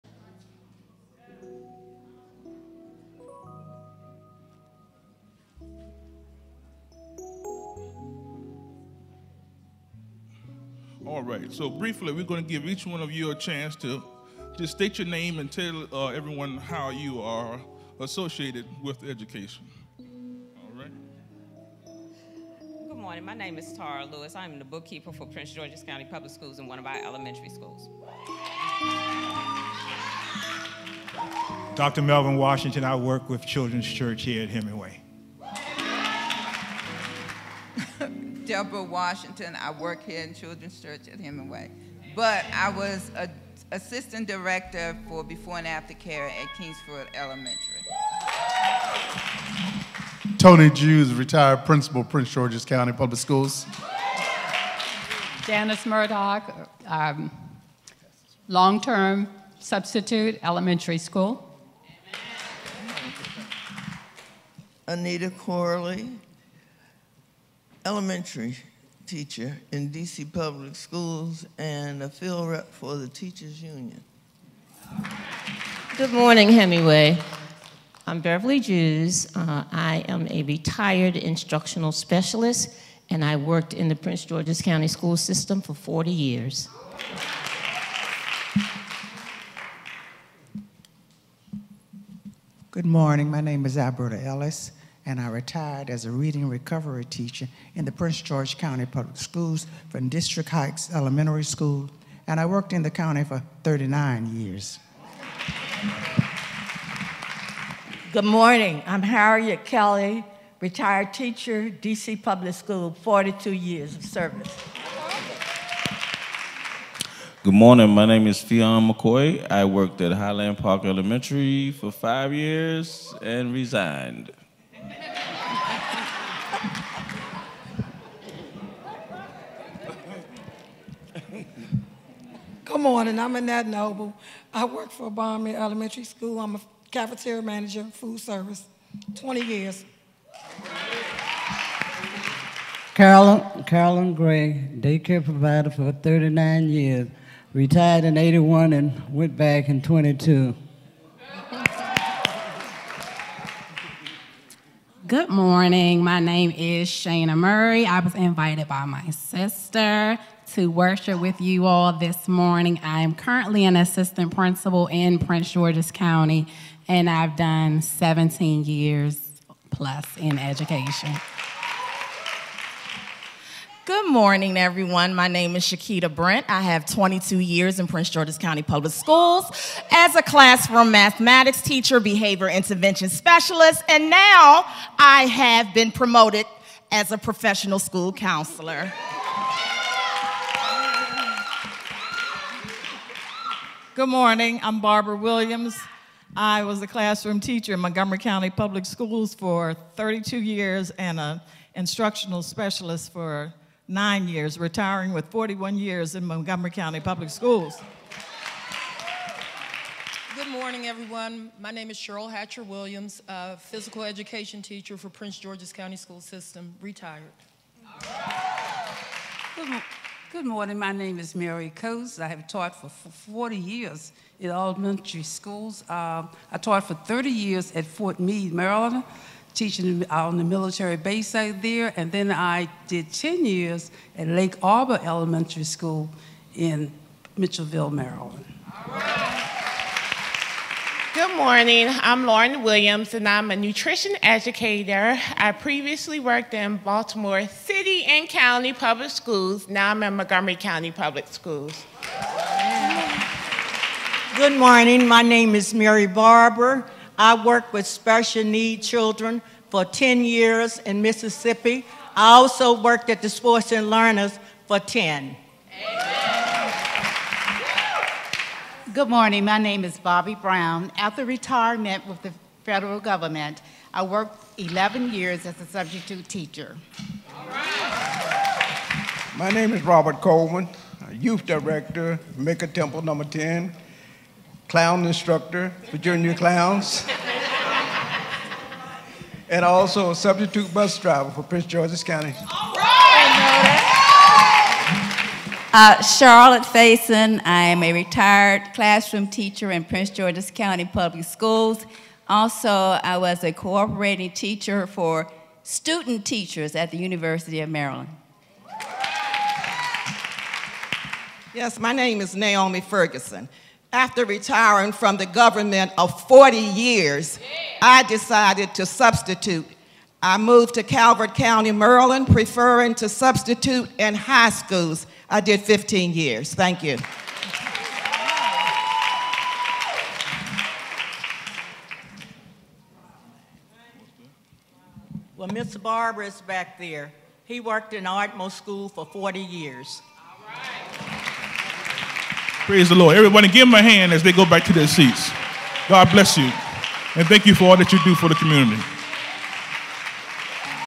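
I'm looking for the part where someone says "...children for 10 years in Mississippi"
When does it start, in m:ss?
4:18.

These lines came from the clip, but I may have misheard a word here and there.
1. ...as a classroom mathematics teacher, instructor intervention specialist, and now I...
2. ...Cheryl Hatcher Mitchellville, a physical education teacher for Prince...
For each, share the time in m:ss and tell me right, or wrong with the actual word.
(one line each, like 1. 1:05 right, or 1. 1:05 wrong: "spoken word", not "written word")
1. 2:59 wrong: "behavior", not "instructor"
2. 3:31 wrong: "Williams", not "Mitchellville".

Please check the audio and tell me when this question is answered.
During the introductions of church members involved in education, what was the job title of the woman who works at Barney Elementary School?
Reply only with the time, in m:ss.
2:16.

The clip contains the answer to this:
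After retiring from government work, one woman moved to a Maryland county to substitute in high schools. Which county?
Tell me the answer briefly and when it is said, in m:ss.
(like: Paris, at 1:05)
Calvert County, at 5:20.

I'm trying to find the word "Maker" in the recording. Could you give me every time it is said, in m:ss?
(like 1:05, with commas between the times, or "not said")
4:42.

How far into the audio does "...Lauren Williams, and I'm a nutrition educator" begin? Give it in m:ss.
4:02.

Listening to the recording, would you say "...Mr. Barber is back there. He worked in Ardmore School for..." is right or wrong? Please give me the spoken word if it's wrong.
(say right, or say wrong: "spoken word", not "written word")
right.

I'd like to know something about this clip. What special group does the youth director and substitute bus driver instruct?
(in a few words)
clown instructor.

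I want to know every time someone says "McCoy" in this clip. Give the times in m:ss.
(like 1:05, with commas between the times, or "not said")
1:58.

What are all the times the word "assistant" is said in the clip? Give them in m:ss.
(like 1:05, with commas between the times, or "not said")
0:43, 2:43.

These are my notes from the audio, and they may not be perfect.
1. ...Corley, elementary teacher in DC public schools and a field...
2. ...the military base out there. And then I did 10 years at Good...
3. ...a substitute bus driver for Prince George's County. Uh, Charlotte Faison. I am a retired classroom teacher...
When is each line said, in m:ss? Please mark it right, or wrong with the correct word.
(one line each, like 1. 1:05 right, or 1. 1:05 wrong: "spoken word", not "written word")
1. 1:05 right
2. 3:50 wrong: "Lake", not "Good"
3. 4:50 right.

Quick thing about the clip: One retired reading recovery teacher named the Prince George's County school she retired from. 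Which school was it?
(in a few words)
District Heights Elementary School.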